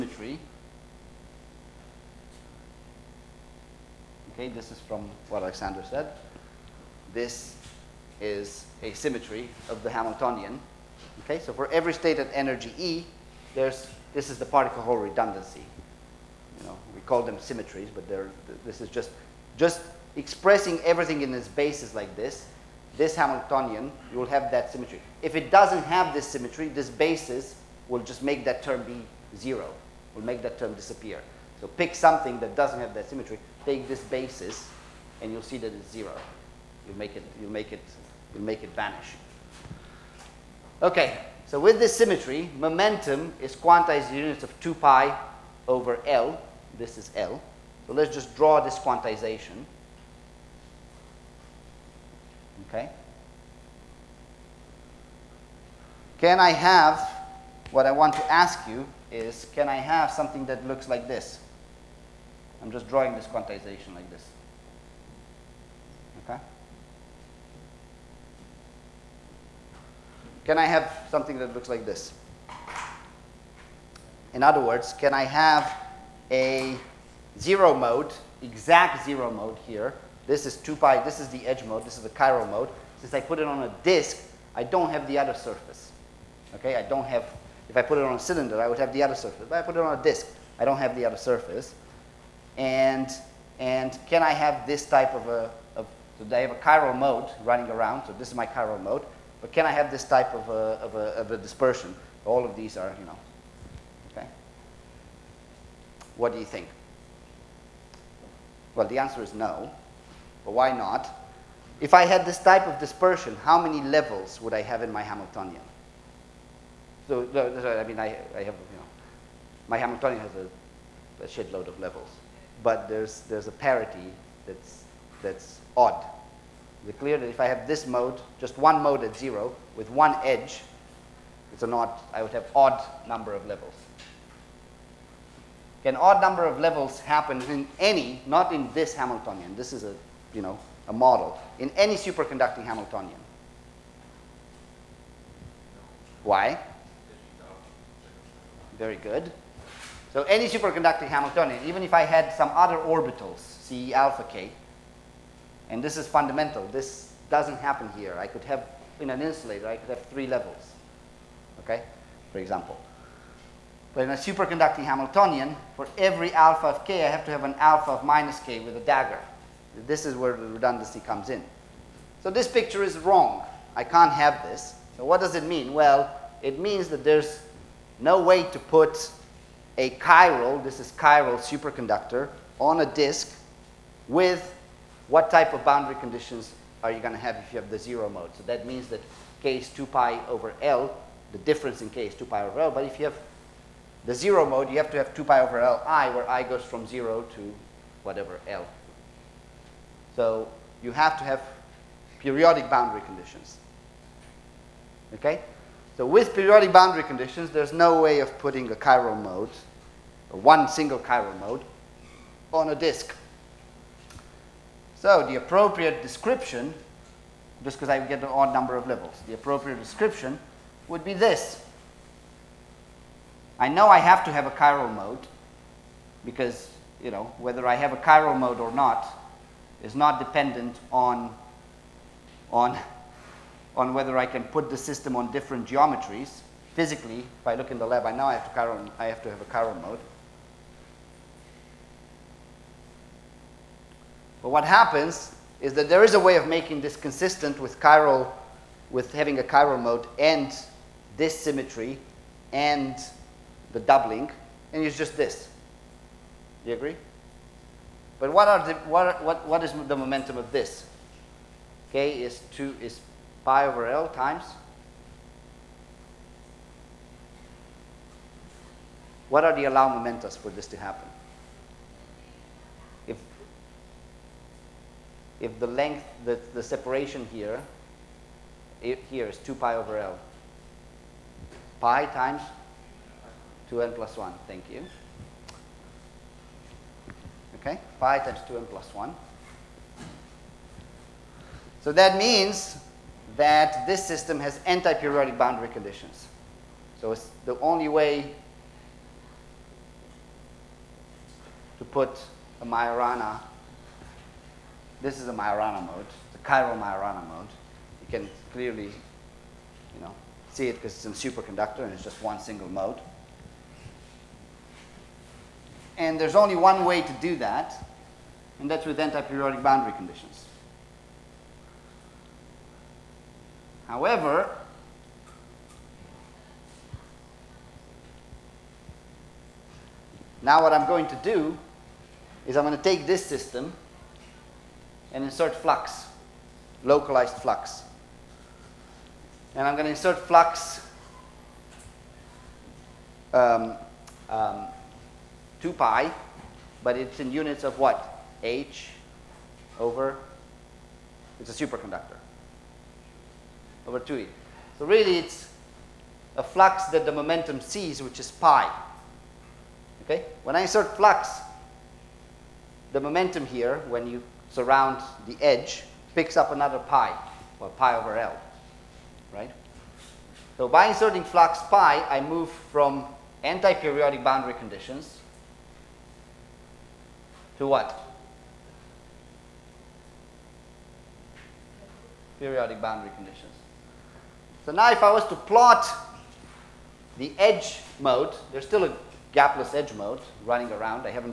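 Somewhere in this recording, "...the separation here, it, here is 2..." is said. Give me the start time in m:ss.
4:36.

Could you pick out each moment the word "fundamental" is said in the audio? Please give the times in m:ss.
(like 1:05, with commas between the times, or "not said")
2:36.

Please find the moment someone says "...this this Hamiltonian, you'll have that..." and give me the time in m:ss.
0:22.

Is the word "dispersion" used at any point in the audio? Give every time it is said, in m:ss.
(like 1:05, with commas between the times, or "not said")
1:41, 1:52.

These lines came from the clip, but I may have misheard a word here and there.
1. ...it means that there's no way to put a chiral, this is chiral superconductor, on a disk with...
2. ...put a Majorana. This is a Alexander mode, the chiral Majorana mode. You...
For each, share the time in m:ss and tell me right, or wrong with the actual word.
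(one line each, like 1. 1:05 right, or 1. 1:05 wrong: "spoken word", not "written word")
1. 2:56 right
2. 5:01 wrong: "Majorana", not "Alexander".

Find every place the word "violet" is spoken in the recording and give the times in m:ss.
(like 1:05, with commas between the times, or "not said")
not said.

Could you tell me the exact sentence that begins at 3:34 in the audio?
So the appropriate description, just because I get an odd number of levels, the appropriate description would be this.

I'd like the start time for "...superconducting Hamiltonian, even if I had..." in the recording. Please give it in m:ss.
2:30.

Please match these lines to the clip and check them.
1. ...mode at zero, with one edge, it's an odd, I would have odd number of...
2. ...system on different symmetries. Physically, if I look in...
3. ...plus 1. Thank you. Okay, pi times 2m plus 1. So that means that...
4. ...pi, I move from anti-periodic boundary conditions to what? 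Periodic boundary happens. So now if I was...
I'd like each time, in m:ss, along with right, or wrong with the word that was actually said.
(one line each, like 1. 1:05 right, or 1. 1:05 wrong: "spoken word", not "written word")
1. 2:08 right
2. 3:54 wrong: "geometries", not "symmetries"
3. 4:43 right
4. 6:11 wrong: "conditions", not "happens".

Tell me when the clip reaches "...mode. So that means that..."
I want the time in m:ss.
3:08.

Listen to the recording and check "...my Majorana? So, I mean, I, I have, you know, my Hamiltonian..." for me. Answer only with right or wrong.
wrong.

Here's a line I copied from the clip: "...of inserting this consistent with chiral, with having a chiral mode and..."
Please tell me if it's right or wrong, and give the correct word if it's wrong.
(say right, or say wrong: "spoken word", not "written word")
wrong: "making", not "inserting".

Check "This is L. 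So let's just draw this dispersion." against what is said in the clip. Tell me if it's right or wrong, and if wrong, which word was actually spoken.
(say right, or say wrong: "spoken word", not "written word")
wrong: "quantization", not "dispersion".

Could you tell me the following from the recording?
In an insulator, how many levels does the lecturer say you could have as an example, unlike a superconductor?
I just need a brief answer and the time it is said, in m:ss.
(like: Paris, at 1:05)
3, at 2:40.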